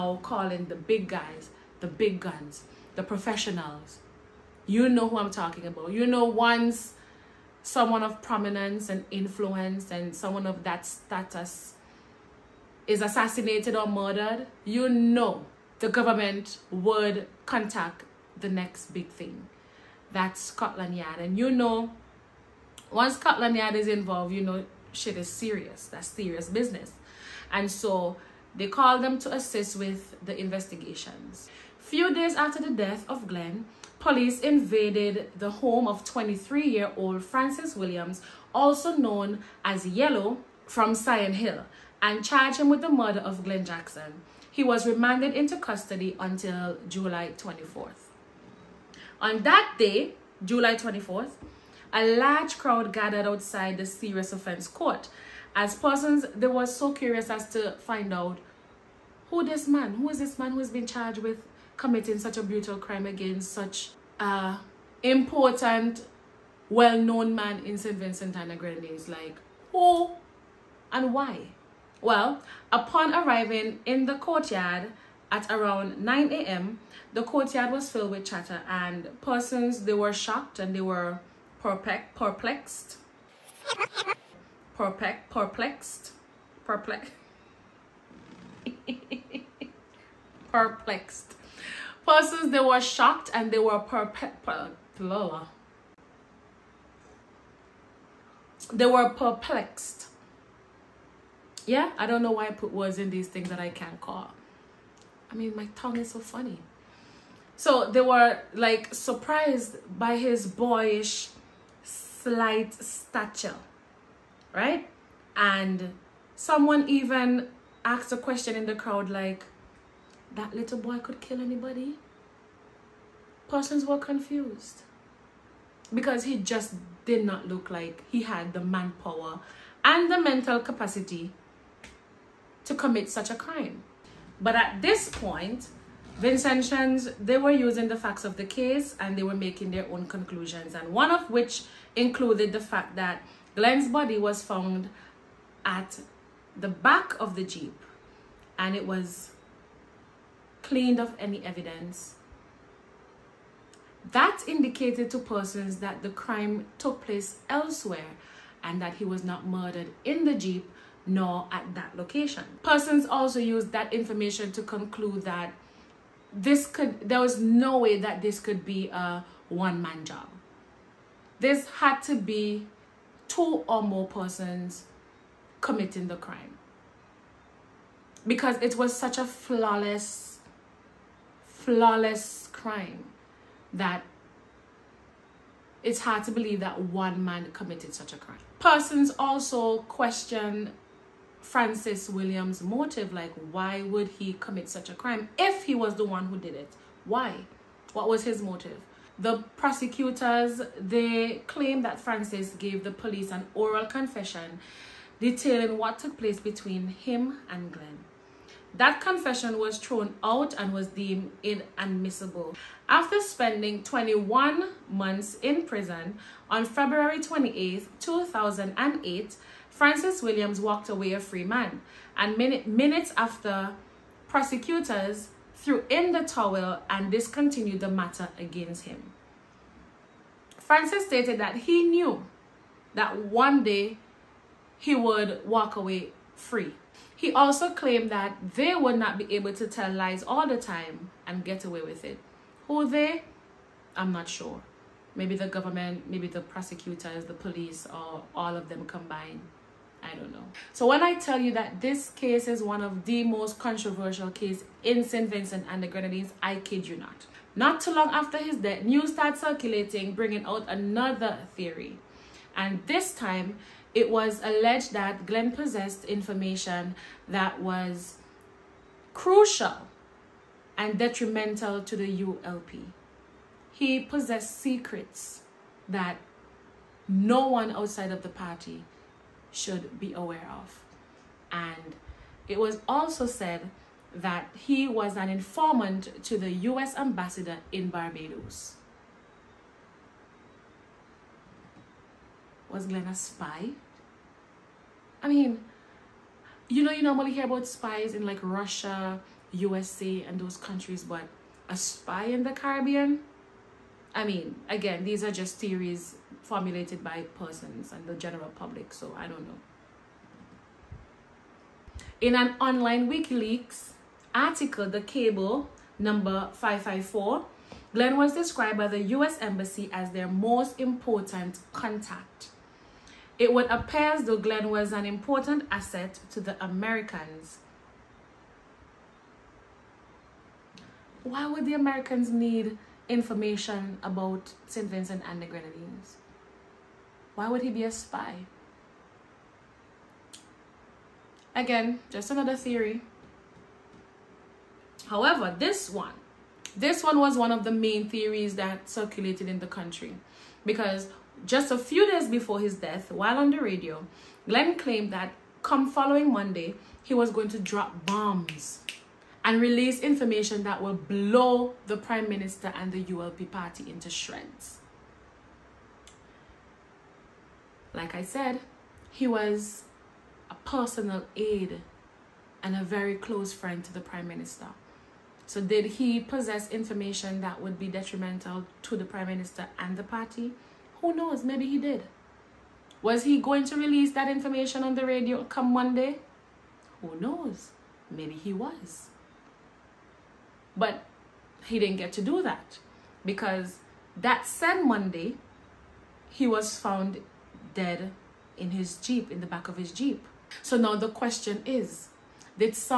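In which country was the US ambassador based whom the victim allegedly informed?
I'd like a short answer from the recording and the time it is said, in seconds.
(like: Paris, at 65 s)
Barbados, at 287 s.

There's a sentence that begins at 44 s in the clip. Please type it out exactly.
He was remanded into custody until July 24th.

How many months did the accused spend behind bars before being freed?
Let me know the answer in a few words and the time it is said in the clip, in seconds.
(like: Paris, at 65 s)
21 months, at 213 s.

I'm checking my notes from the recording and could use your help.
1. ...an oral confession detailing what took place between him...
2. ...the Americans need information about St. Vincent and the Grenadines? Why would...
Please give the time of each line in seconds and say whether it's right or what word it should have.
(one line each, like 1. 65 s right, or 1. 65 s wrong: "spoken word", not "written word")
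1. 203 s right
2. 331 s right.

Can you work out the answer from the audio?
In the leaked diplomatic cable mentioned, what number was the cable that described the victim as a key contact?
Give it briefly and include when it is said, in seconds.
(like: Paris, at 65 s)
554, at 316 s.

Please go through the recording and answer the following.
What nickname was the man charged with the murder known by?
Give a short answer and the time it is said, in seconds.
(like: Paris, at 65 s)
Yellow, at 39 s.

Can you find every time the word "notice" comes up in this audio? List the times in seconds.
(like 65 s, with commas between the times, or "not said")
not said.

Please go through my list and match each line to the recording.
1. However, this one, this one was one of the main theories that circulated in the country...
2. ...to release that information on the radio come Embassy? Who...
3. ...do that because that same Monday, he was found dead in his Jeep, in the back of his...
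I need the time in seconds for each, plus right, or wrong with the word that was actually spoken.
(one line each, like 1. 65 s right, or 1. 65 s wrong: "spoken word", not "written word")
1. 345 s right
2. 383 s wrong: "Monday", not "Embassy"
3. 392 s right.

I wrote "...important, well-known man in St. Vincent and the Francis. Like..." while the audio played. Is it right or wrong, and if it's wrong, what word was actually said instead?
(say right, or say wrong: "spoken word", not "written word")
wrong: "Grenadines", not "Francis".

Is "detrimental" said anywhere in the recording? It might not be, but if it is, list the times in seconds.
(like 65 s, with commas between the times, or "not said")
270 s, 377 s.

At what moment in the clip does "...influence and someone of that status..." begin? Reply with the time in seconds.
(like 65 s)
9 s.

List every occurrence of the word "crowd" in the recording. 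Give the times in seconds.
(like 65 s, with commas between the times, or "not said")
52 s, 118 s.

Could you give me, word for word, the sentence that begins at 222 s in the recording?
And min minutes after, prosecutors threw in the towel and discontinued the matter against him.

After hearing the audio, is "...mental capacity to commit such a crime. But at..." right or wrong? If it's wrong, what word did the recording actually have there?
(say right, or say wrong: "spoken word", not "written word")
right.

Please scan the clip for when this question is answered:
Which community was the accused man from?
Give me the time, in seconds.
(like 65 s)
40 s.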